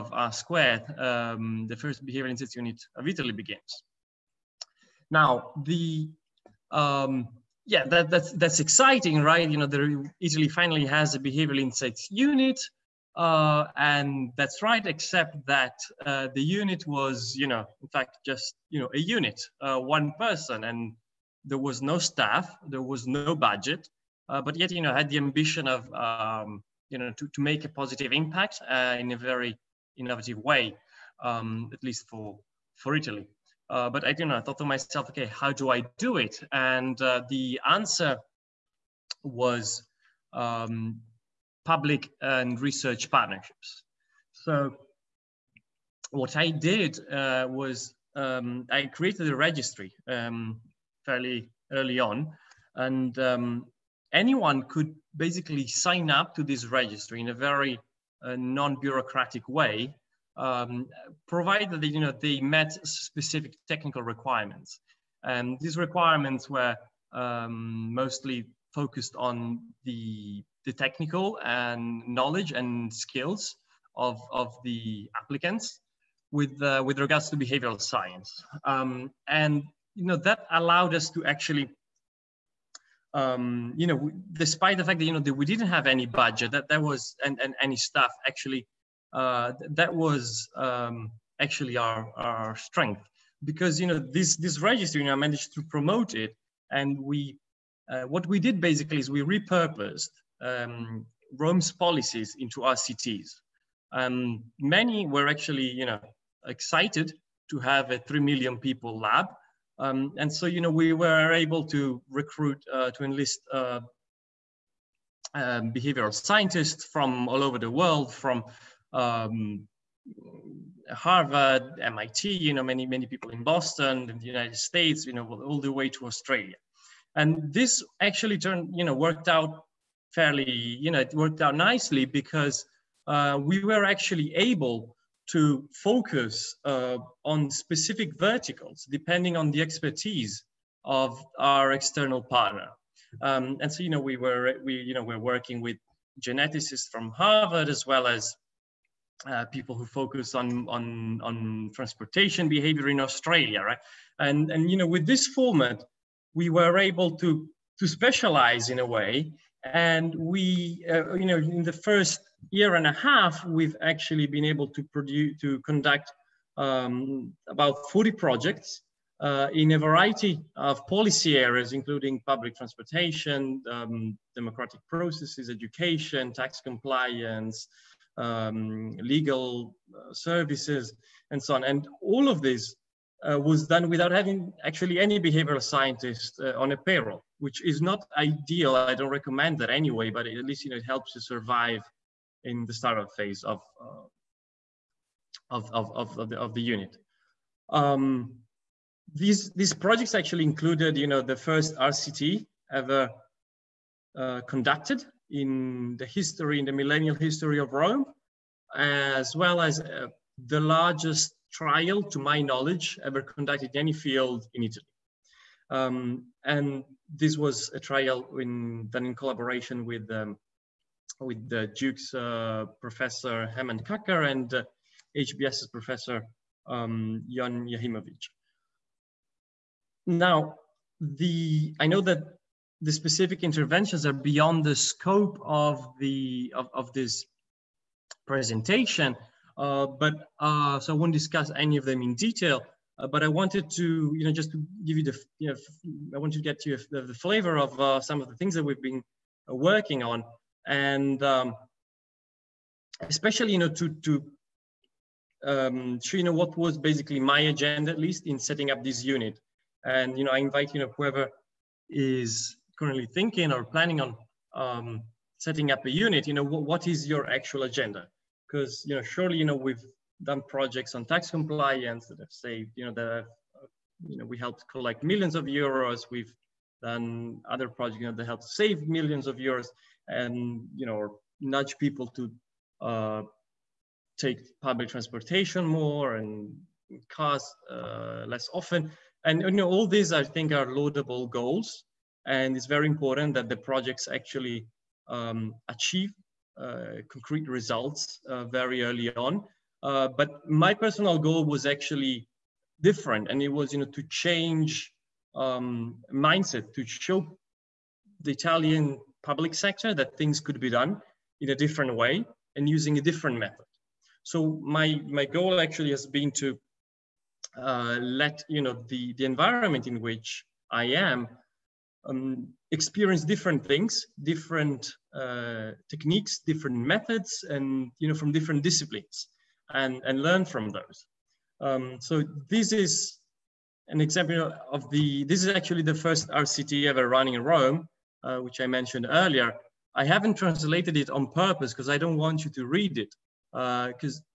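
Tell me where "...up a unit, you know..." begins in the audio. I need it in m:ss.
4:25.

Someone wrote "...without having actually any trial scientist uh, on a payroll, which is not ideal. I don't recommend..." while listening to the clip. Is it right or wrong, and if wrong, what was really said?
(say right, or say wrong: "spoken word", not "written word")
wrong: "behavioral", not "trial".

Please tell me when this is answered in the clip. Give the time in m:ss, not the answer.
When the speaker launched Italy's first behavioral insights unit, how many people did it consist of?
0:19.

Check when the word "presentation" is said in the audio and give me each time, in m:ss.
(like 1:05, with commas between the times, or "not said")
3:58.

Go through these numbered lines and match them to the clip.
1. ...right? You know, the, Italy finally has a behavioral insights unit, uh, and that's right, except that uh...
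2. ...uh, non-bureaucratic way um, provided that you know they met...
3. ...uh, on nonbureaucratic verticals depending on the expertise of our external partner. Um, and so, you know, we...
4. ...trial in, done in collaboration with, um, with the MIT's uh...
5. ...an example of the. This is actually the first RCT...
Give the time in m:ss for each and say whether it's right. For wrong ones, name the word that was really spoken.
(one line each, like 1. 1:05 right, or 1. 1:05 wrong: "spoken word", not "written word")
1. 0:09 right
2. 0:58 right
3. 2:16 wrong: "specific", not "nonbureaucratic"
4. 3:37 wrong: "Duke", not "MIT"
5. 5:33 right.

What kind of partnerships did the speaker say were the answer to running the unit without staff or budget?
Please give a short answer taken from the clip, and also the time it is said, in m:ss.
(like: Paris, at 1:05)
Public and research partnerships, at 0:41.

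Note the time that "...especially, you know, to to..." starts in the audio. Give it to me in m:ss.
4:13.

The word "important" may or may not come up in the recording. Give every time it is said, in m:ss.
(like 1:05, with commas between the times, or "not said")
4:52.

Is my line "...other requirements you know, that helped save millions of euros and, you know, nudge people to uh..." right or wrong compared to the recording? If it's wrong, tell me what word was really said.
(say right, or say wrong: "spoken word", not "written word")
wrong: "projects", not "requirements".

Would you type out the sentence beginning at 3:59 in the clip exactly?
Uh, but uh, so I won't discuss any of them in detail.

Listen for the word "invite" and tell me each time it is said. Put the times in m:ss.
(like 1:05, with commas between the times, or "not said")
4:20.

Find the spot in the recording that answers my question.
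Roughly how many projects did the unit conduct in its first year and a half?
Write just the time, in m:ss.
2:47.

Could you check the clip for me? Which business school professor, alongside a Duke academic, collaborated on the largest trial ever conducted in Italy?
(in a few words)
Jon Jachimowicz.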